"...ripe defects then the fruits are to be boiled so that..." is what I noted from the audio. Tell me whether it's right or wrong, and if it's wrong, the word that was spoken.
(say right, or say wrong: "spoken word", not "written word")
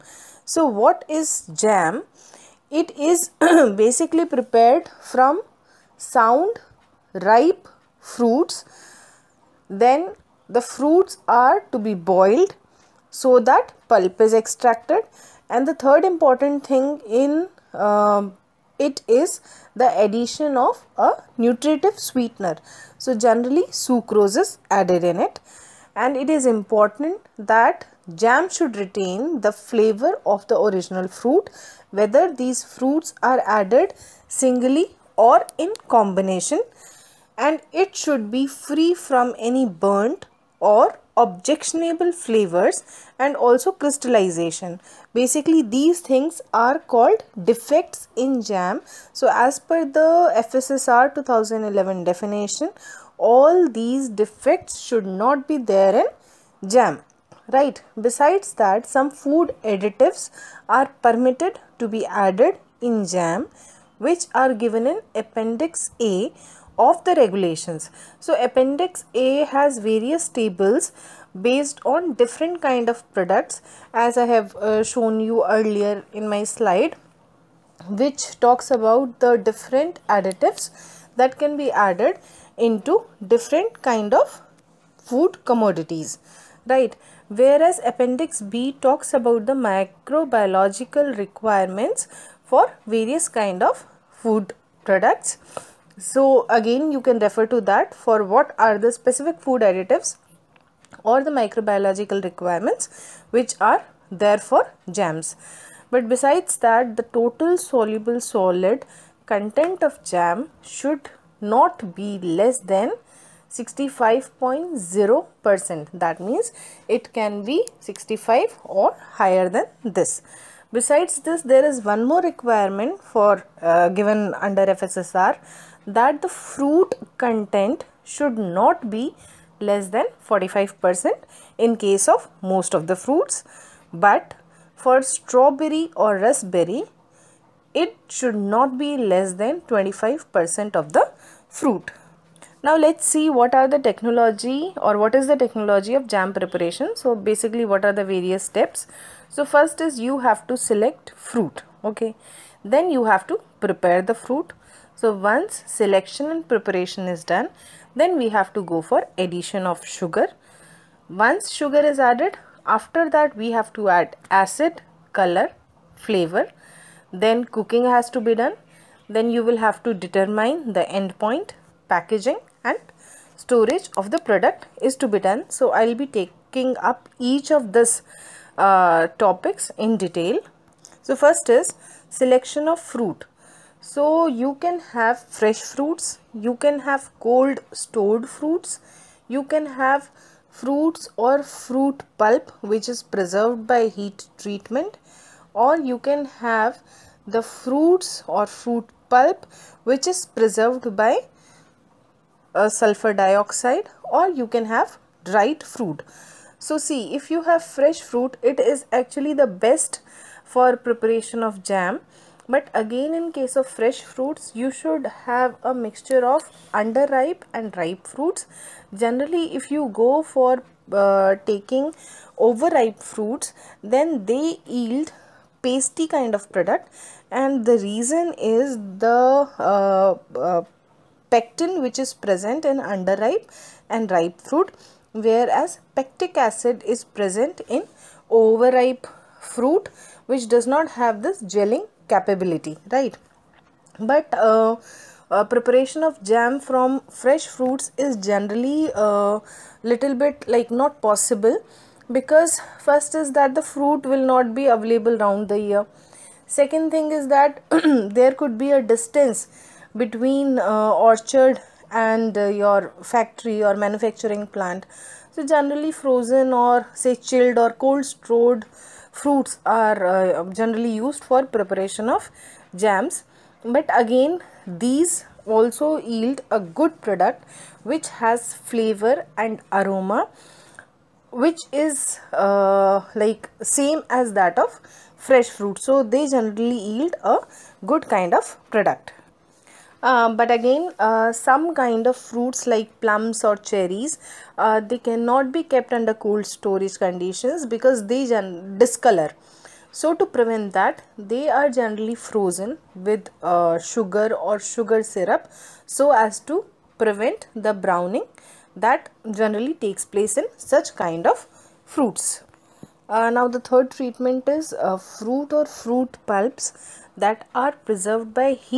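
wrong: "fruits", not "defects".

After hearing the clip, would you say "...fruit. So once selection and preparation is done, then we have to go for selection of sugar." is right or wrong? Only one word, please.
wrong.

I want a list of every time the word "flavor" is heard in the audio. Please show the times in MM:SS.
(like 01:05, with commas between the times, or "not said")
00:29, 00:42, 02:45, 04:38.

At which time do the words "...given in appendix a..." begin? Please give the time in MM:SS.
01:04.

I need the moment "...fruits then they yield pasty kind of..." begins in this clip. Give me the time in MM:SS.
03:43.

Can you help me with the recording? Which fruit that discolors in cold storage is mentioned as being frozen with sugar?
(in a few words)
plums.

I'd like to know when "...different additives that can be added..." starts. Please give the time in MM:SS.
01:19.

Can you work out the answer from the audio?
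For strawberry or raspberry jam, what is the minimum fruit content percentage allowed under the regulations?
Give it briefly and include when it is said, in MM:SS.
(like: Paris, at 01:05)
25%, at 02:19.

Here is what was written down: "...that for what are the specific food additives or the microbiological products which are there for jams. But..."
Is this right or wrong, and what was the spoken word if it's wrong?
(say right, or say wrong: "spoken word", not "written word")
wrong: "requirements", not "products".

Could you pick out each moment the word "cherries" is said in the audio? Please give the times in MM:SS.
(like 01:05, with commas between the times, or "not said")
04:53.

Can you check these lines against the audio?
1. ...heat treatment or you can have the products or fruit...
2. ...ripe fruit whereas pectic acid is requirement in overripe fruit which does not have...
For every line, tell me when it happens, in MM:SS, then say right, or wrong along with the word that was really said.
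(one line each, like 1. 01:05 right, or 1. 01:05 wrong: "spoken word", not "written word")
1. 03:13 wrong: "fruits", not "products"
2. 03:54 wrong: "present", not "requirement".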